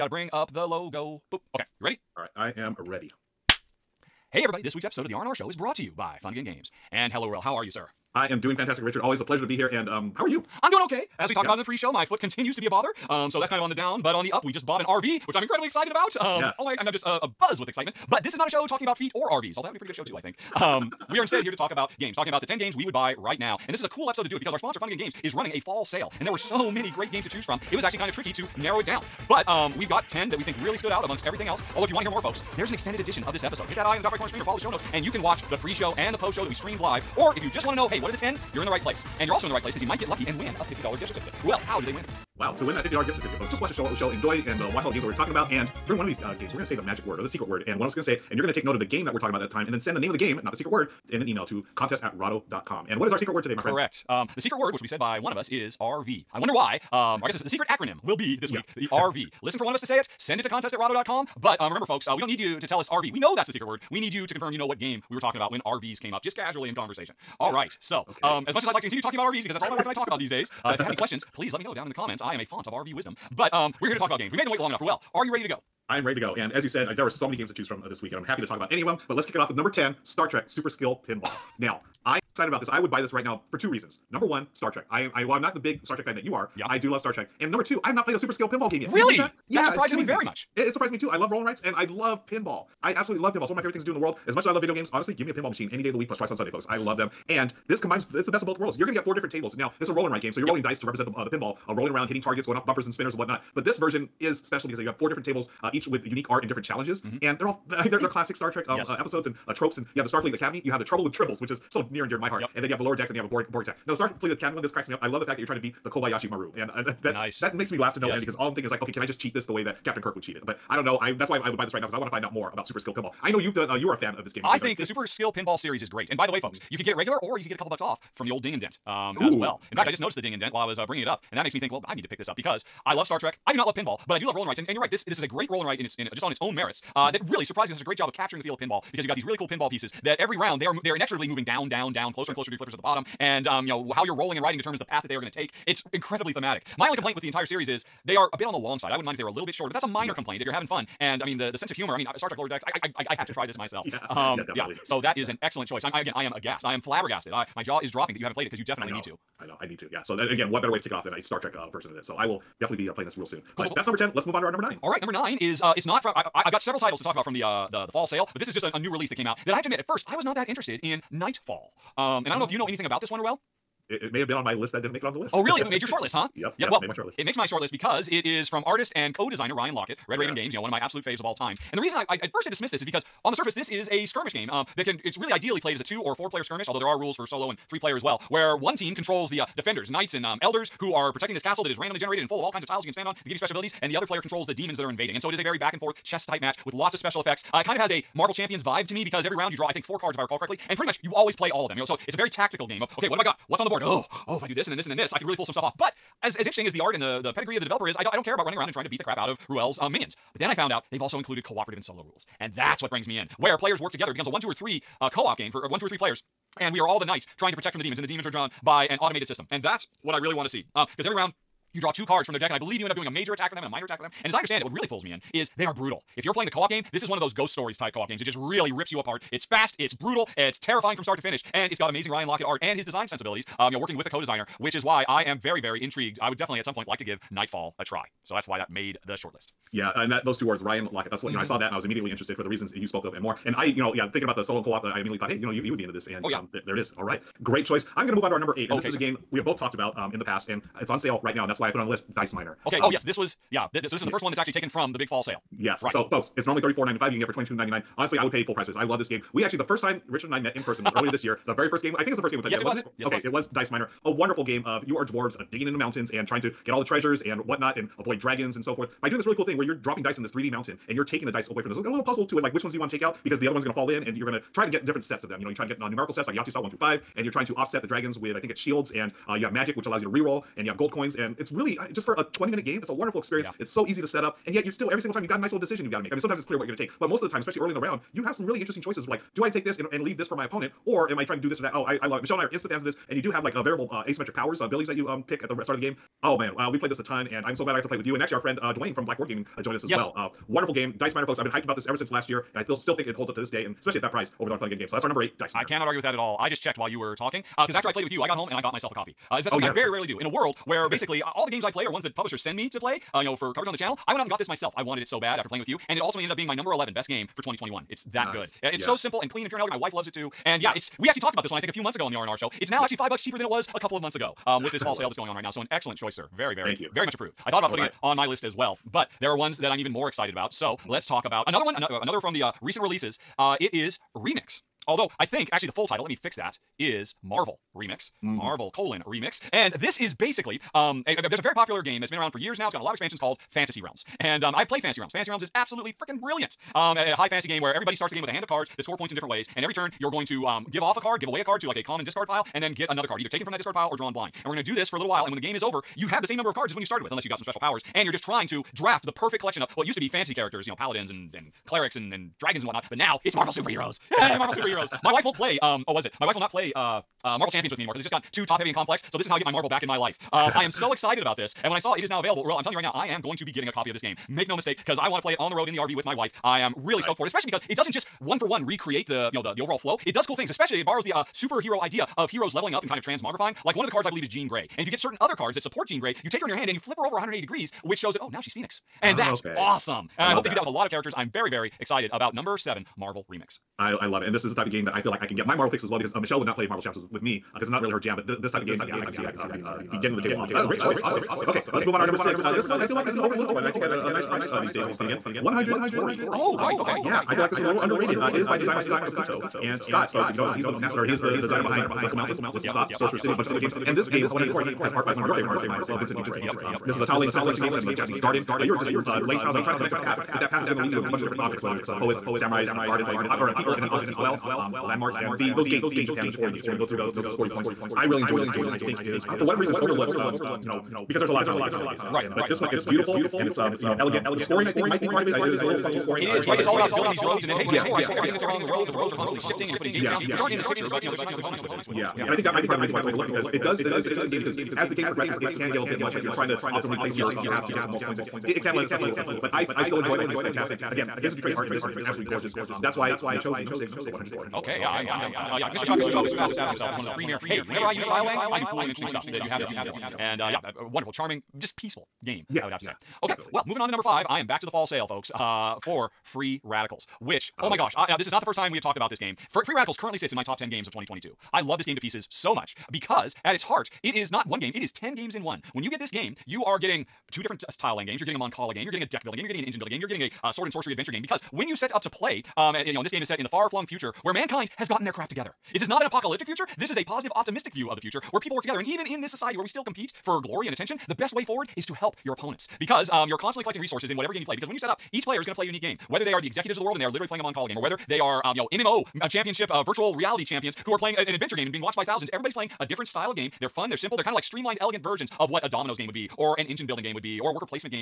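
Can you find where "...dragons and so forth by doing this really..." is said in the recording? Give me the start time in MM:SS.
04:28.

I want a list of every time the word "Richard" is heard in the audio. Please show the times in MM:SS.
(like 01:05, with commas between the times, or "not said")
00:08, 04:20.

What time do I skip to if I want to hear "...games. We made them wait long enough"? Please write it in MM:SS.
01:14.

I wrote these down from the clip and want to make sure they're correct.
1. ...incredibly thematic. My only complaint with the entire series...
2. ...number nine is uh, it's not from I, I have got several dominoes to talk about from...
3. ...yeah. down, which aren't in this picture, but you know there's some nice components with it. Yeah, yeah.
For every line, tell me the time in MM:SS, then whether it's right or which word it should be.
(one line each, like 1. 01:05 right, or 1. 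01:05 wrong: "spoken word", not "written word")
1. 02:25 right
2. 02:45 wrong: "titles", not "dominoes"
3. 07:20 right.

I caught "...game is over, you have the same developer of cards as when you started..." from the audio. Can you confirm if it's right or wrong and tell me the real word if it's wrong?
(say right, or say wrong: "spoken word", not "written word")
wrong: "number", not "developer".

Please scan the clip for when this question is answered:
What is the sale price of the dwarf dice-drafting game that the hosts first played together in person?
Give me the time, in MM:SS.
04:17.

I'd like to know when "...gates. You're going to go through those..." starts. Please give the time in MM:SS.
07:06.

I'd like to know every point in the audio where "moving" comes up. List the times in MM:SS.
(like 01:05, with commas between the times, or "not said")
02:21, 07:43.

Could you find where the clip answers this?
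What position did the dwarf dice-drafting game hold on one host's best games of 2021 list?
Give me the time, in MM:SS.
05:16.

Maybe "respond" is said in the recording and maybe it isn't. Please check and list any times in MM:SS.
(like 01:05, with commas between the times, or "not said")
not said.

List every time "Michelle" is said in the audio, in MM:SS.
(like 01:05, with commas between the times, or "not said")
04:52, 06:36.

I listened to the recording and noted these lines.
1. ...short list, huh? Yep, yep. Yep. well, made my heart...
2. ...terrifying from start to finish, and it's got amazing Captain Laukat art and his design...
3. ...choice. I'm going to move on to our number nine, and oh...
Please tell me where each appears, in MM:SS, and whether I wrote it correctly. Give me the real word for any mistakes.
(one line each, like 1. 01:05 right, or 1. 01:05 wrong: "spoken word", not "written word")
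1. 02:55 wrong: "short", not "heart"
2. 03:50 wrong: "Ryan", not "Captain"
3. 04:07 wrong: "eight", not "nine".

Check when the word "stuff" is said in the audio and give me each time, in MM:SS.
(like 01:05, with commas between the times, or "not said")
03:25, 07:39.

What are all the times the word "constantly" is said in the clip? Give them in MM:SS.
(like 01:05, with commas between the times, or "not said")
07:19, 08:13.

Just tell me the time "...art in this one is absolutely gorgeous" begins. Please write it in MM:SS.
07:31.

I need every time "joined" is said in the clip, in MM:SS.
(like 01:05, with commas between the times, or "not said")
04:59.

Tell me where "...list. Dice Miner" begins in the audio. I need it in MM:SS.
04:11.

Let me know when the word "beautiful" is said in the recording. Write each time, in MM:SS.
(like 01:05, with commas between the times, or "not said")
07:12.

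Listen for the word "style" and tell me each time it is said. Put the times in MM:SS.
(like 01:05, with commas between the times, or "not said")
04:36, 08:23.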